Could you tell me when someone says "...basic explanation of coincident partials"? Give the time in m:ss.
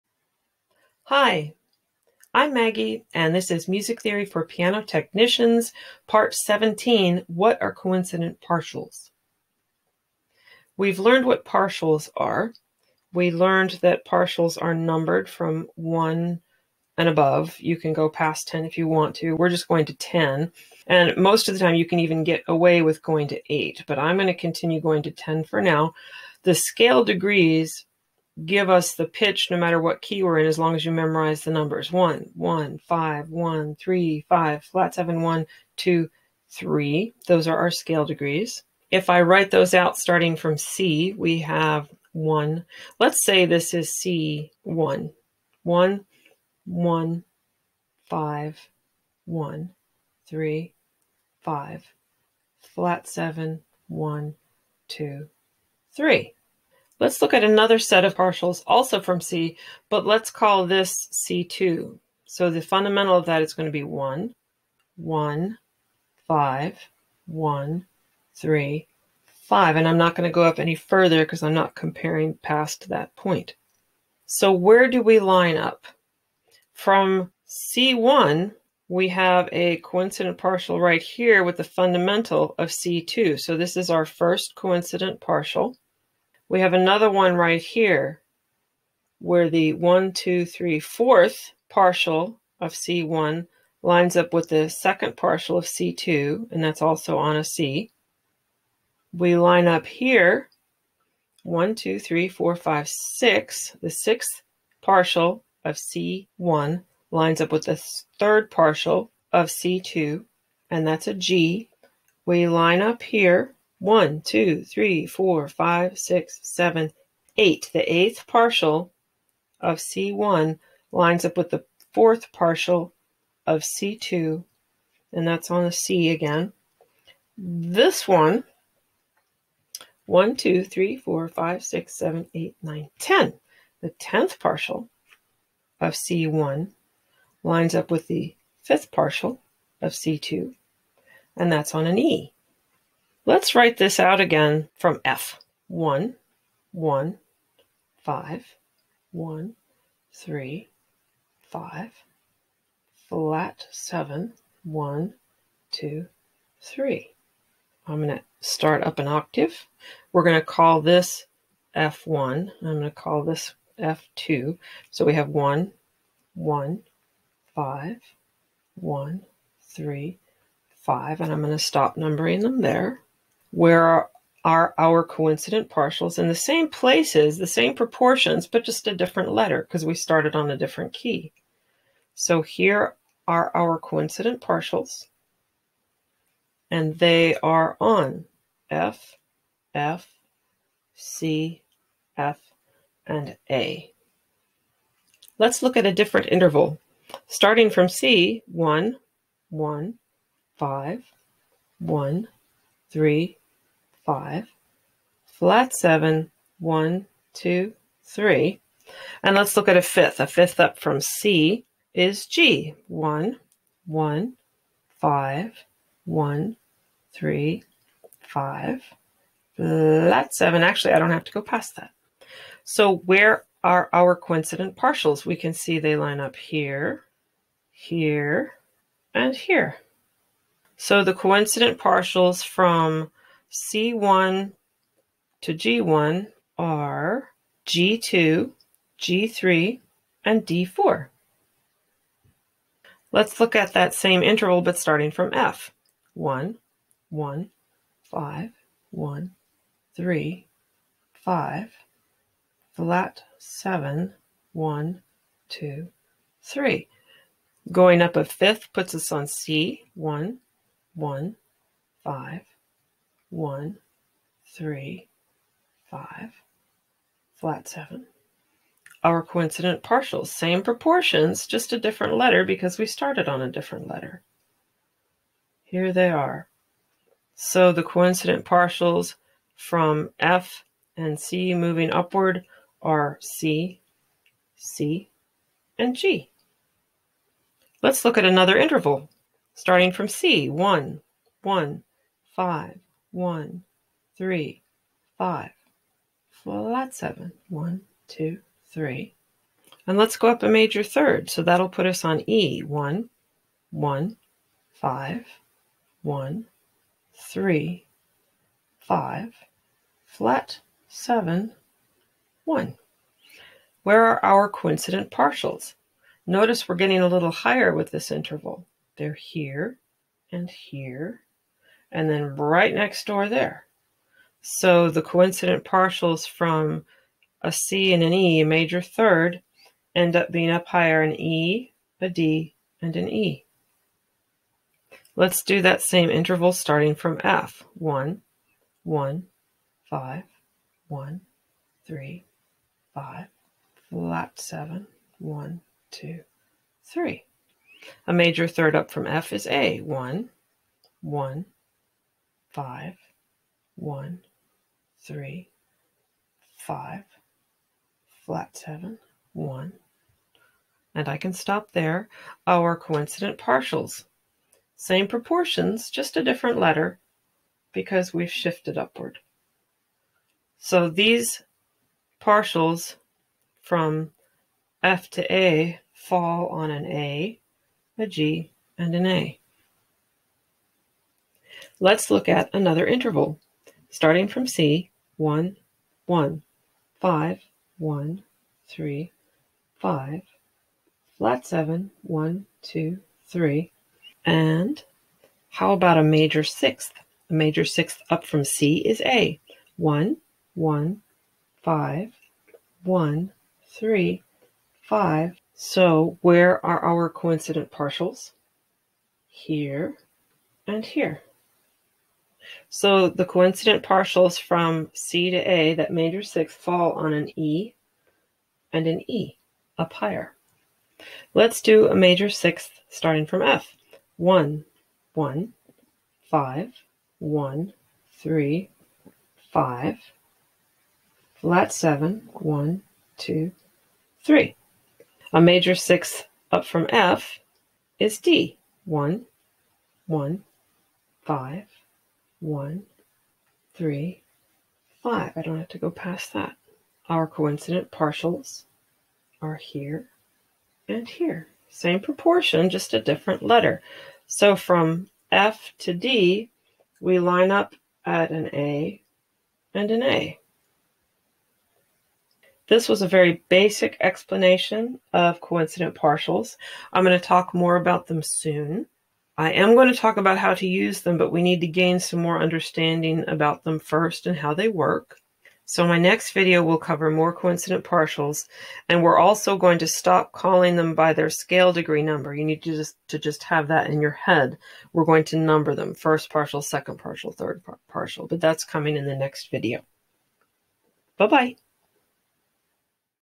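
7:43.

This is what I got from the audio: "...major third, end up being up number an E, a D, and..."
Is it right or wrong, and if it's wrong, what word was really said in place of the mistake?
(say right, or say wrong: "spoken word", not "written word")
wrong: "higher", not "number".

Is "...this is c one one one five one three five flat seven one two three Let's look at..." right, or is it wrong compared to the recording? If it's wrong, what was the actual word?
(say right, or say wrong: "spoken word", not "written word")
right.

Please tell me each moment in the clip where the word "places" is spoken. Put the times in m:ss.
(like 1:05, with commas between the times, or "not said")
2:56.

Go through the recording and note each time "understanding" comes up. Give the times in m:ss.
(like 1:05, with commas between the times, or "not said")
7:52.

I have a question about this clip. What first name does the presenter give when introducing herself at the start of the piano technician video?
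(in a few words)
Maggie.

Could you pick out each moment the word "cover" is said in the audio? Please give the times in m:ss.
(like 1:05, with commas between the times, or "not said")
7:56.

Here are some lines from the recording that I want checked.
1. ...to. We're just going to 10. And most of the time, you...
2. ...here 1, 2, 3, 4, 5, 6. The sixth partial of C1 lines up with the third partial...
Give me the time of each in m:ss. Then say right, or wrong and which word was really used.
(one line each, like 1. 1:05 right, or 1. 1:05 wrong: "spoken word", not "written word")
1. 0:19 right
2. 1:39 right.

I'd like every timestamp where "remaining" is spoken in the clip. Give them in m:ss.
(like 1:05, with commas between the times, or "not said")
not said.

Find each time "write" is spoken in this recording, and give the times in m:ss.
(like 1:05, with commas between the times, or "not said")
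0:39, 2:23.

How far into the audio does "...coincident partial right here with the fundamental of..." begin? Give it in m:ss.
1:19.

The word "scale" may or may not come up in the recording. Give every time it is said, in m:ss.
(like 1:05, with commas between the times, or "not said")
0:26, 0:37, 8:01.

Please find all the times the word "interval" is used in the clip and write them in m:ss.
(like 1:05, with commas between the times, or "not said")
3:16, 4:04, 4:48, 5:18, 5:36, 6:22.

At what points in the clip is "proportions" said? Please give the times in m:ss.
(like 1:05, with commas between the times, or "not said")
2:57, 4:30, 6:05, 7:31.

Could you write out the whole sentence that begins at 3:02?
So here are our coincident partials, and they are on F, F, C, F, and A.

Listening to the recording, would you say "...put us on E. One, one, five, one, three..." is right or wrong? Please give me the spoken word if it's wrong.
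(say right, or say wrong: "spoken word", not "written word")
right.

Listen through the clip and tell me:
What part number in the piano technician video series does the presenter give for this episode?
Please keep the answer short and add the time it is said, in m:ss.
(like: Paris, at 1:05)
17, at 0:06.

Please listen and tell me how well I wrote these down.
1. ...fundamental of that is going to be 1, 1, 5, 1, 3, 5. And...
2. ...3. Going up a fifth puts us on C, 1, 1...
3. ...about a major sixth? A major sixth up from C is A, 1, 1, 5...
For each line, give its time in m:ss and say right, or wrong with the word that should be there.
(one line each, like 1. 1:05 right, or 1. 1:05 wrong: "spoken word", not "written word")
1. 1:02 right
2. 4:16 right
3. 6:35 right.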